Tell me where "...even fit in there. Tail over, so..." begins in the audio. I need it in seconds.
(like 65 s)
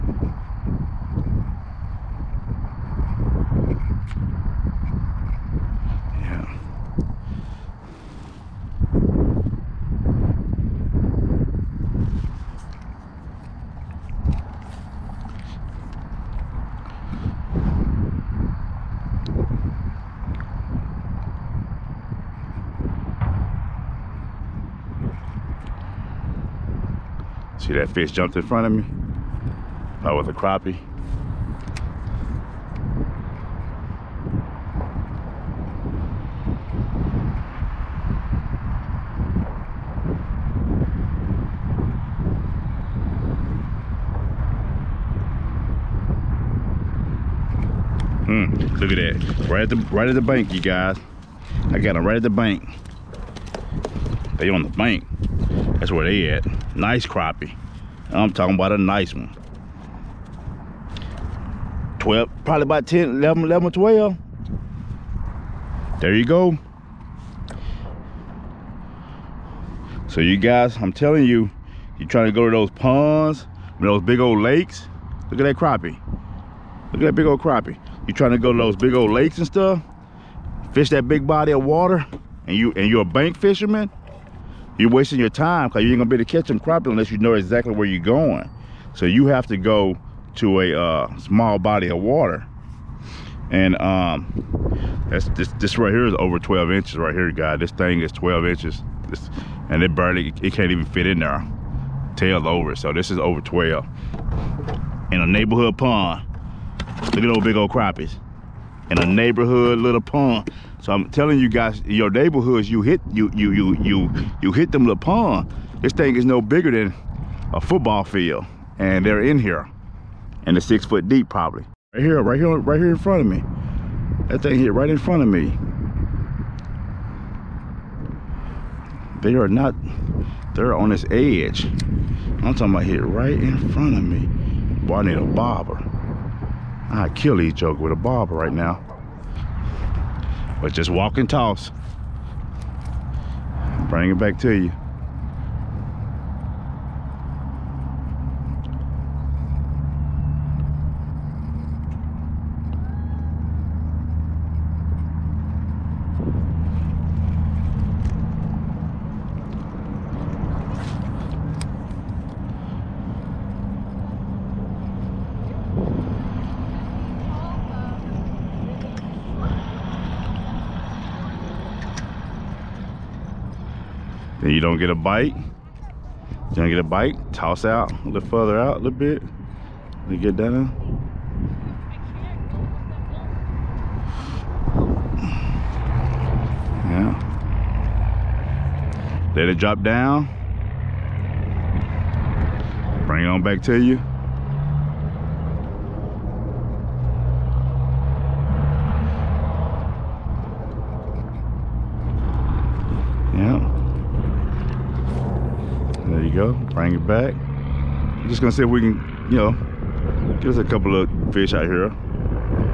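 100 s.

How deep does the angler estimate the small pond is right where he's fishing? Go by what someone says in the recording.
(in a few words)
6 feet.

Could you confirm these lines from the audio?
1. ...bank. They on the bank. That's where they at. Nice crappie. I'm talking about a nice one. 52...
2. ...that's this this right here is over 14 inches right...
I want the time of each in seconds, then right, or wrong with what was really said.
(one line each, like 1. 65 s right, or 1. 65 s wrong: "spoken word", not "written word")
1. 52 s wrong: "12", not "52"
2. 95 s wrong: "12", not "14".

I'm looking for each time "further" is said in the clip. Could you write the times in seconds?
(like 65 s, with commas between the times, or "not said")
178 s.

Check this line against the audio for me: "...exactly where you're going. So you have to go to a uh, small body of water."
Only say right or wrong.
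right.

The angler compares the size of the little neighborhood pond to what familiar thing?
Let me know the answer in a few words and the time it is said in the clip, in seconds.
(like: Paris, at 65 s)
A football field, at 117 s.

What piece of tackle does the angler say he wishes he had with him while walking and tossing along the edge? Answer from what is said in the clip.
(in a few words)
A bobber.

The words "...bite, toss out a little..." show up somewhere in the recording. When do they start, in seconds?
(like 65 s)
176 s.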